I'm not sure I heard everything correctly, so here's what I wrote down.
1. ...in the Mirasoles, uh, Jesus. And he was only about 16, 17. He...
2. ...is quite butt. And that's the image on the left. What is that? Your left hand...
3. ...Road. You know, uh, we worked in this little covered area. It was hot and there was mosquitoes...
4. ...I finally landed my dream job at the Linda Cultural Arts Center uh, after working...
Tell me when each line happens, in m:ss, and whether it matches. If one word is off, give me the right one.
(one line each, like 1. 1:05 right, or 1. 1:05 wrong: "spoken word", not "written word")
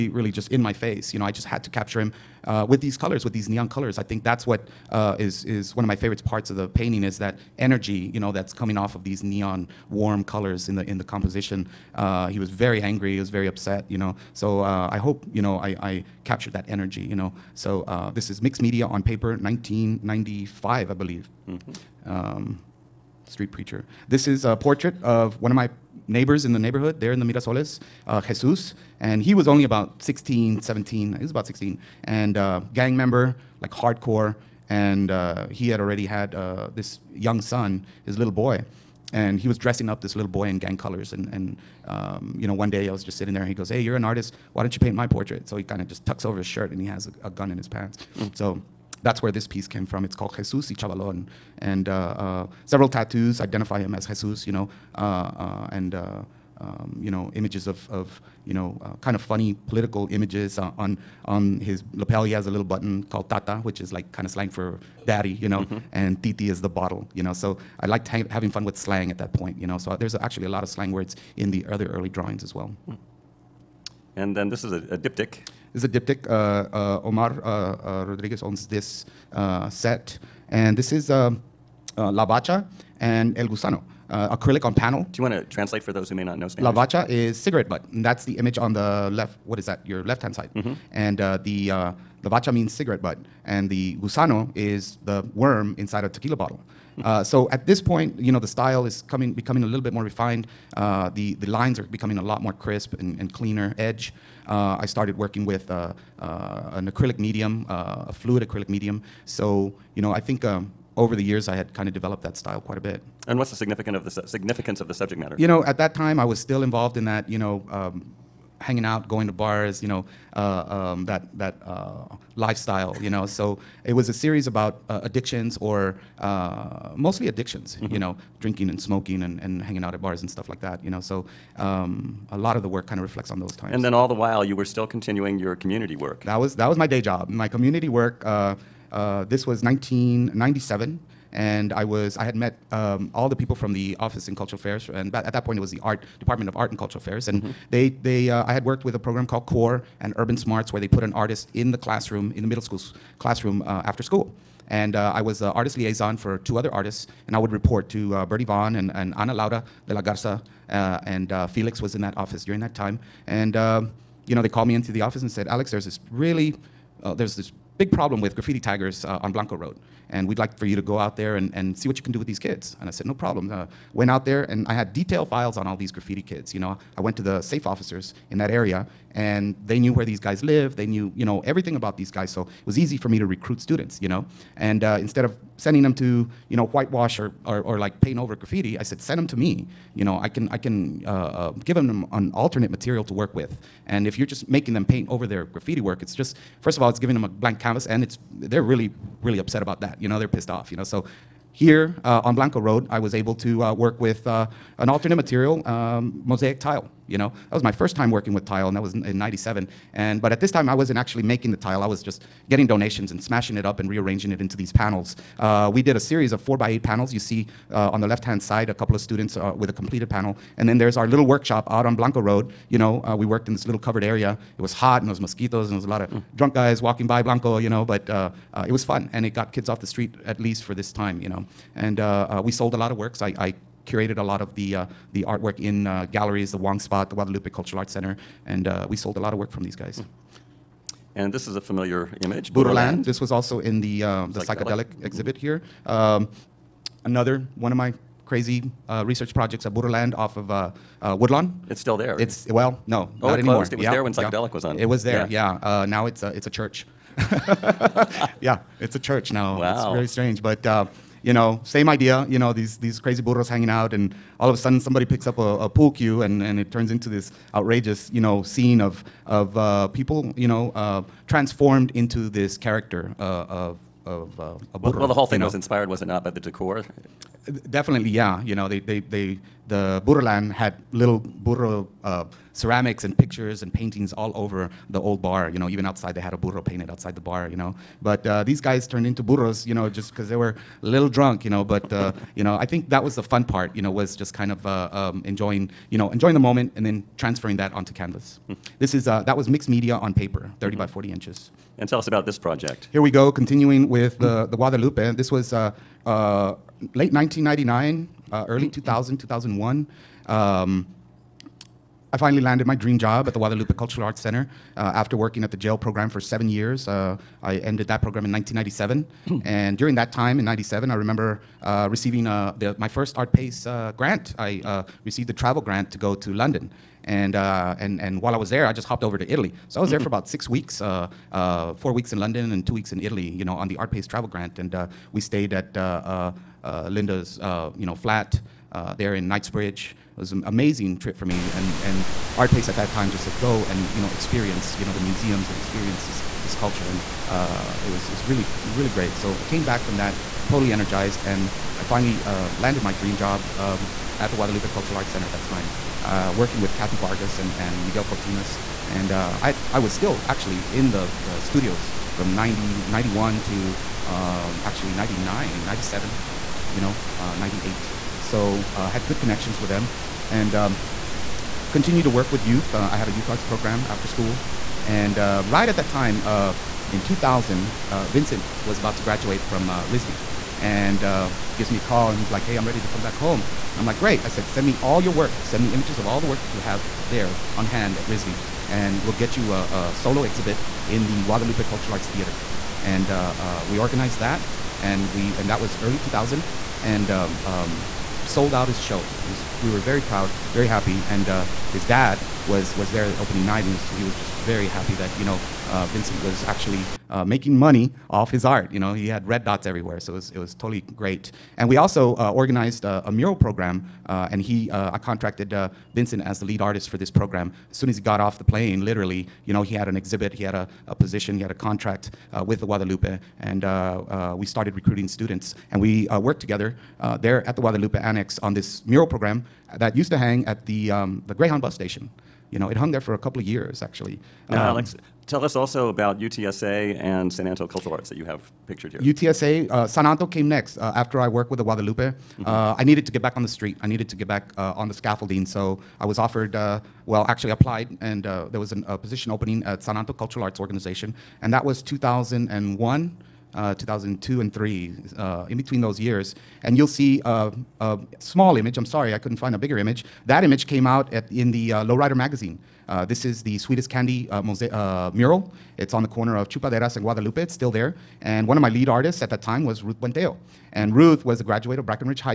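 1. 0:27 right
2. 1:27 wrong: "cigarette", not "quite"
3. 3:42 right
4. 5:12 wrong: "Guadalupe", not "Linda".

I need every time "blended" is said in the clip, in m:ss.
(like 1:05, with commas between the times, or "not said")
not said.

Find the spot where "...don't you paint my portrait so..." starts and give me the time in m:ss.
0:44.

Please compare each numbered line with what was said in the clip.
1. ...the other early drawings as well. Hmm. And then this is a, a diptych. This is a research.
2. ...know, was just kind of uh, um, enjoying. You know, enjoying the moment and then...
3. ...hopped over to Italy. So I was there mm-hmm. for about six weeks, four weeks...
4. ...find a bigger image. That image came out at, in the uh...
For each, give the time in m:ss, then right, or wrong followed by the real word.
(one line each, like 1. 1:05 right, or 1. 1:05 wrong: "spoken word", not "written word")
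1. 1:11 wrong: "diptych", not "research"
2. 4:53 right
3. 5:28 right
4. 7:39 right.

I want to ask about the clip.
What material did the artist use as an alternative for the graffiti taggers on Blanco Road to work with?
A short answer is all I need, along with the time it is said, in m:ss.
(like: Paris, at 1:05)
mosaic tile, at 3:26.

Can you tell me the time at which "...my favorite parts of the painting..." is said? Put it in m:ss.
0:05.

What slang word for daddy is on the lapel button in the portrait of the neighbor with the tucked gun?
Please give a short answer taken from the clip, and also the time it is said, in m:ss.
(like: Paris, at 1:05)
Tata, at 1:03.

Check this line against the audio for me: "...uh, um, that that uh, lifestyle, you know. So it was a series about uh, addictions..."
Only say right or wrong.
right.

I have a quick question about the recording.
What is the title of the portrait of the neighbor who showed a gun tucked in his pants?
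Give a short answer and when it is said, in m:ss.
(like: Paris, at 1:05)
Jesus y Chavalon, at 0:50.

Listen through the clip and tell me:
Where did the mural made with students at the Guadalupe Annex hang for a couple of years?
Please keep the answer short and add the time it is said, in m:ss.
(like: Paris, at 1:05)
Greyhound bus station, at 7:11.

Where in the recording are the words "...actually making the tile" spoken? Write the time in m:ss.
3:30.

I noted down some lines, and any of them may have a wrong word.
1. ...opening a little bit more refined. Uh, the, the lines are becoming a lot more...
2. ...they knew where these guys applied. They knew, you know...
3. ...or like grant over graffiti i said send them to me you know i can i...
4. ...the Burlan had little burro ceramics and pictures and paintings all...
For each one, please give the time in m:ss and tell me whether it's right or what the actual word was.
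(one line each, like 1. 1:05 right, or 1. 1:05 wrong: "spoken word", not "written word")
1. 1:39 wrong: "becoming", not "opening"
2. 2:59 wrong: "lived", not "applied"
3. 3:07 wrong: "paint", not "grant"
4. 4:39 right.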